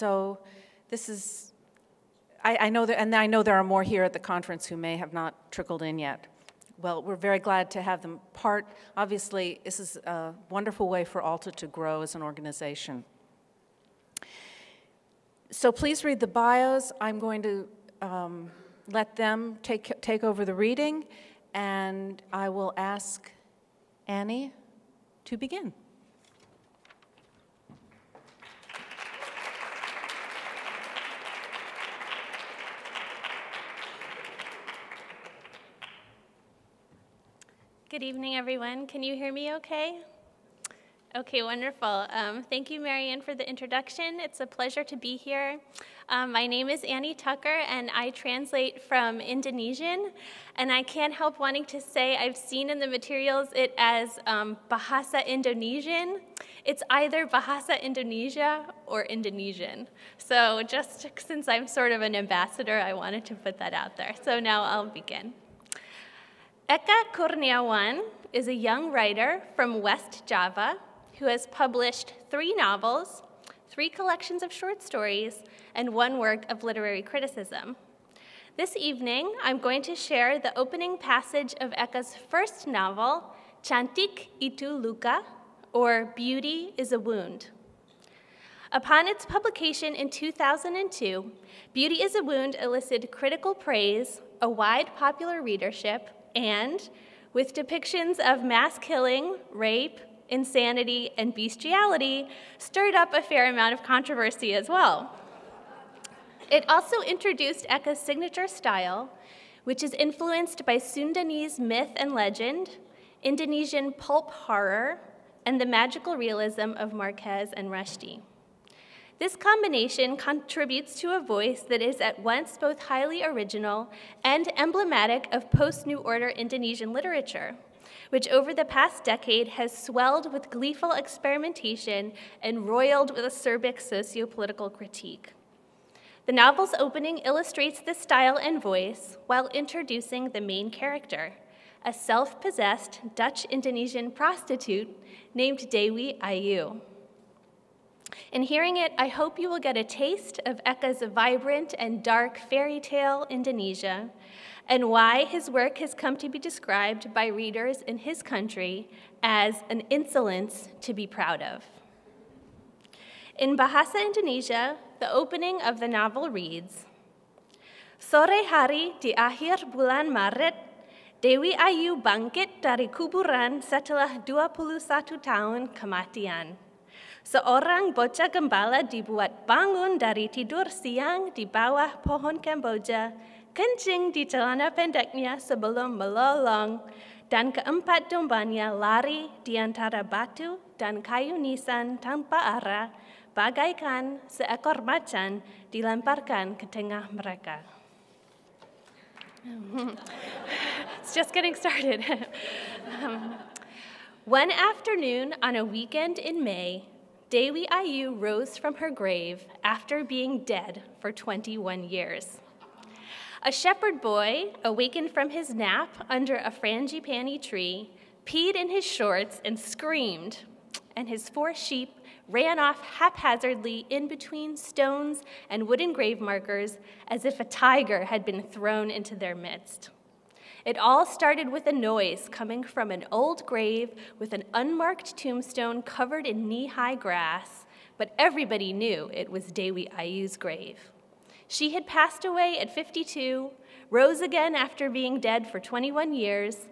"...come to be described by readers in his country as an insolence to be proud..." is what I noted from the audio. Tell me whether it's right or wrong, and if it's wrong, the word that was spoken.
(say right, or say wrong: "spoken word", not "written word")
right.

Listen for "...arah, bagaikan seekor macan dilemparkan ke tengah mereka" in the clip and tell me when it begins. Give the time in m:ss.
3:12.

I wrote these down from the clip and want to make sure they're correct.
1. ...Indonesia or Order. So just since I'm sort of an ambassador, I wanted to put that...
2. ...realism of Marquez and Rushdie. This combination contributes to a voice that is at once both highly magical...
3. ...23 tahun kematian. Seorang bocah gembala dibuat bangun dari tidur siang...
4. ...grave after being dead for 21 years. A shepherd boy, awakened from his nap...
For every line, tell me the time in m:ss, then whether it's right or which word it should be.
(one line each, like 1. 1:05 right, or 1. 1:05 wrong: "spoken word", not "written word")
1. 0:57 wrong: "Indonesian", not "Order"
2. 1:56 wrong: "original", not "magical"
3. 2:54 wrong: "21", not "23"
4. 3:28 right.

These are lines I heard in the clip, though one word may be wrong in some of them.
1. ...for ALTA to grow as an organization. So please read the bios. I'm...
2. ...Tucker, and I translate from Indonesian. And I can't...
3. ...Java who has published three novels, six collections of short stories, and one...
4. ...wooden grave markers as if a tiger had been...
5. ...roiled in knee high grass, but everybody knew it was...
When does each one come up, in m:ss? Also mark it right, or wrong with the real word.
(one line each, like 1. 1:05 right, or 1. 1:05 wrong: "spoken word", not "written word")
1. 0:11 right
2. 0:47 right
3. 1:10 wrong: "three", not "six"
4. 3:45 right
5. 3:55 wrong: "covered", not "roiled".